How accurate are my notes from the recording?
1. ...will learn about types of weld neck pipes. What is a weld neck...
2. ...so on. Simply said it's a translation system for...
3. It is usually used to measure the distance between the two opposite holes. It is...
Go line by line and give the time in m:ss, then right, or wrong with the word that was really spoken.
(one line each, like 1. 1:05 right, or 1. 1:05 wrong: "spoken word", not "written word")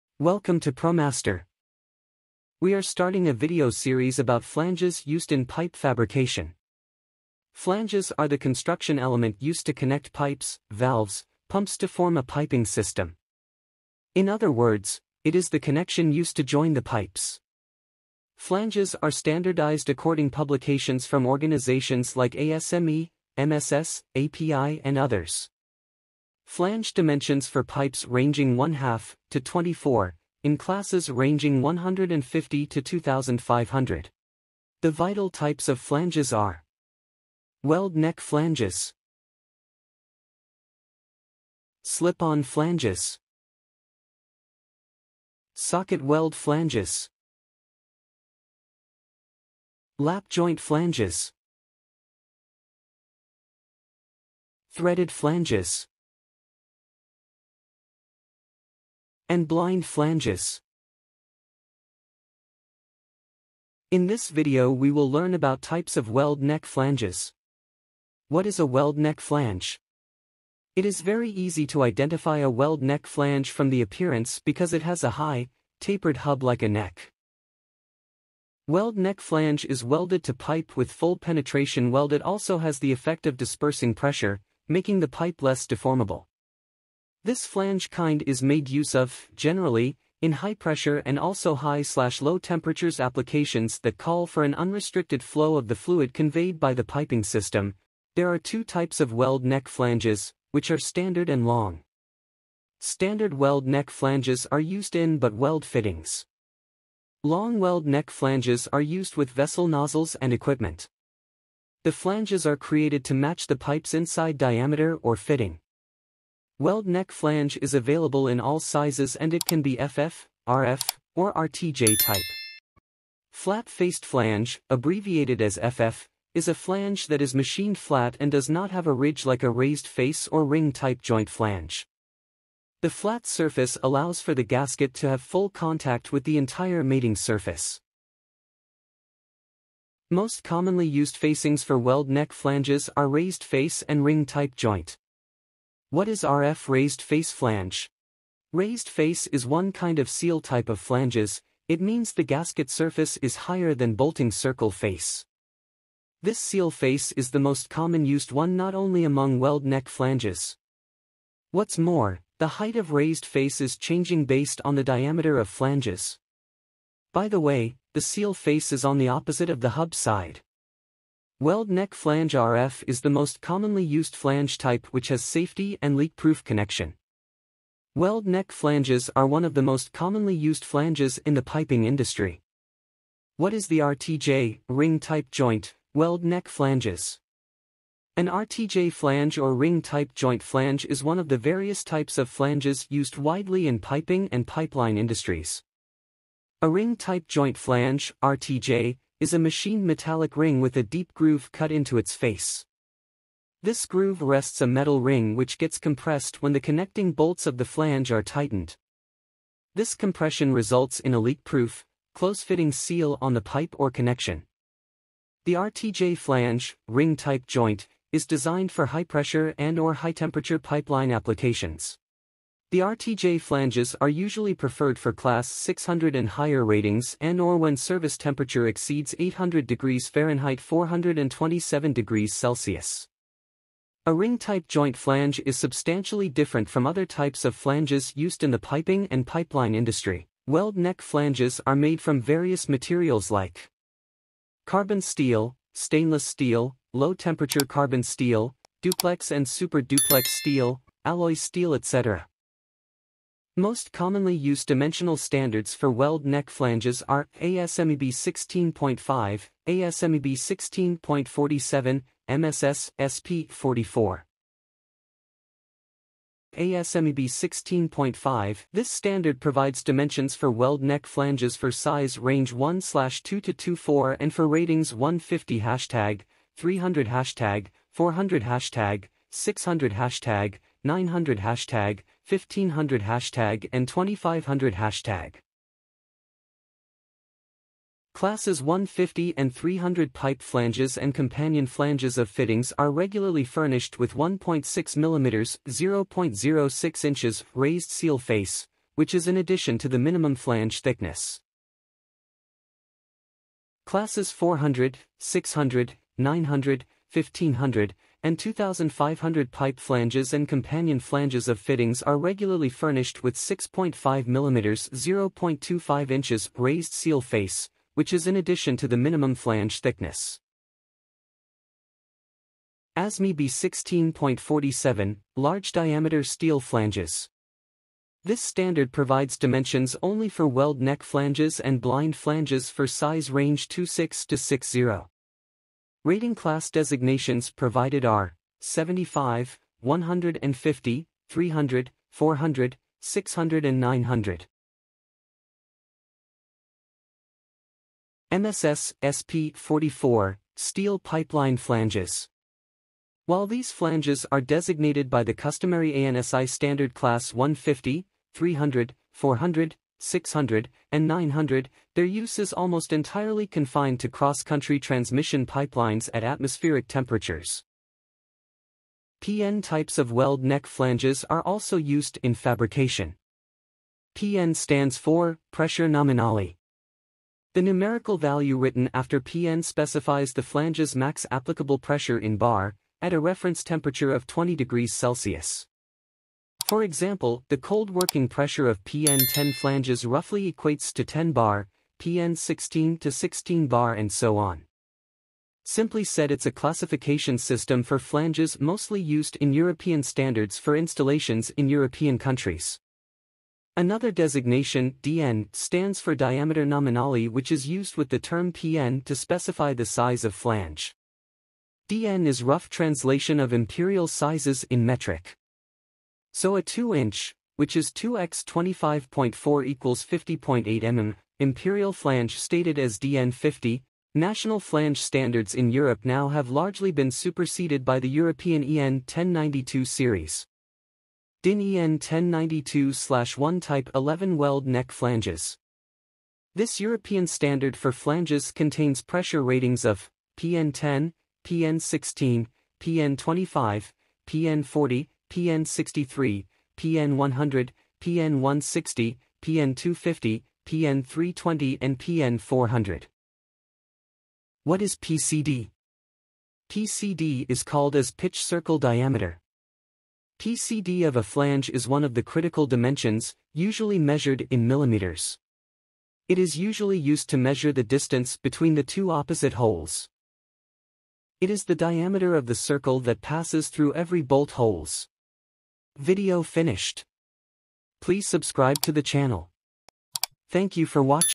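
1. 1:04 wrong: "flanges", not "pipes"
2. 6:34 wrong: "classification", not "translation"
3. 7:46 right.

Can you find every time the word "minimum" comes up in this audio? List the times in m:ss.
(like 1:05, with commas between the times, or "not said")
4:59, 5:18.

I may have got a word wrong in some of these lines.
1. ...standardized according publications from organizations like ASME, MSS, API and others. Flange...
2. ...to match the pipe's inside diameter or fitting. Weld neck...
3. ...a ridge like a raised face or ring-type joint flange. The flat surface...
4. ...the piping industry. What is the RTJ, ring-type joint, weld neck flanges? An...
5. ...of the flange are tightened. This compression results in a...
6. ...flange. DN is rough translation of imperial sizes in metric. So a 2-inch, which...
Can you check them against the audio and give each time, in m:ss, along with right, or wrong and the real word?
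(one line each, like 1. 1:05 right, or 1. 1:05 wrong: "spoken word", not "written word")
1. 0:19 right
2. 1:53 right
3. 2:08 right
4. 3:01 right
5. 3:27 right
6. 6:50 right.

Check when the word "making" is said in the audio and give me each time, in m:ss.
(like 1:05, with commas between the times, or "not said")
1:24.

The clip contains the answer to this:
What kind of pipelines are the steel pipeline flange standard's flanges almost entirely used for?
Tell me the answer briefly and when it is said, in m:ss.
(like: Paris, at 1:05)
Cross-country transmission pipelines, at 6:04.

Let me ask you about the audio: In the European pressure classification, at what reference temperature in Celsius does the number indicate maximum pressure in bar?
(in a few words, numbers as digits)
20 degrees Celsius.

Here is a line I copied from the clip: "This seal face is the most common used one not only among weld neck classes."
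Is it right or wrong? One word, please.
wrong.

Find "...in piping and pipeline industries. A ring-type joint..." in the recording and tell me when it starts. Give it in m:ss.
3:13.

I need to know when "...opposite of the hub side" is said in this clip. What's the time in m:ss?
2:49.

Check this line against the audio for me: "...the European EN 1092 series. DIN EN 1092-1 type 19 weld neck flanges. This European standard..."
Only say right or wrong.
wrong.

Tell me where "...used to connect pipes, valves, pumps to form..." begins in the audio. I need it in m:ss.
0:09.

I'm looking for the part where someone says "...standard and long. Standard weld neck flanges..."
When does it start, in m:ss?
1:40.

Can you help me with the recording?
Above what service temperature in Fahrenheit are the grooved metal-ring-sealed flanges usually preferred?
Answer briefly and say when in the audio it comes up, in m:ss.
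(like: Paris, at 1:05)
800 degrees Fahrenheit, at 3:49.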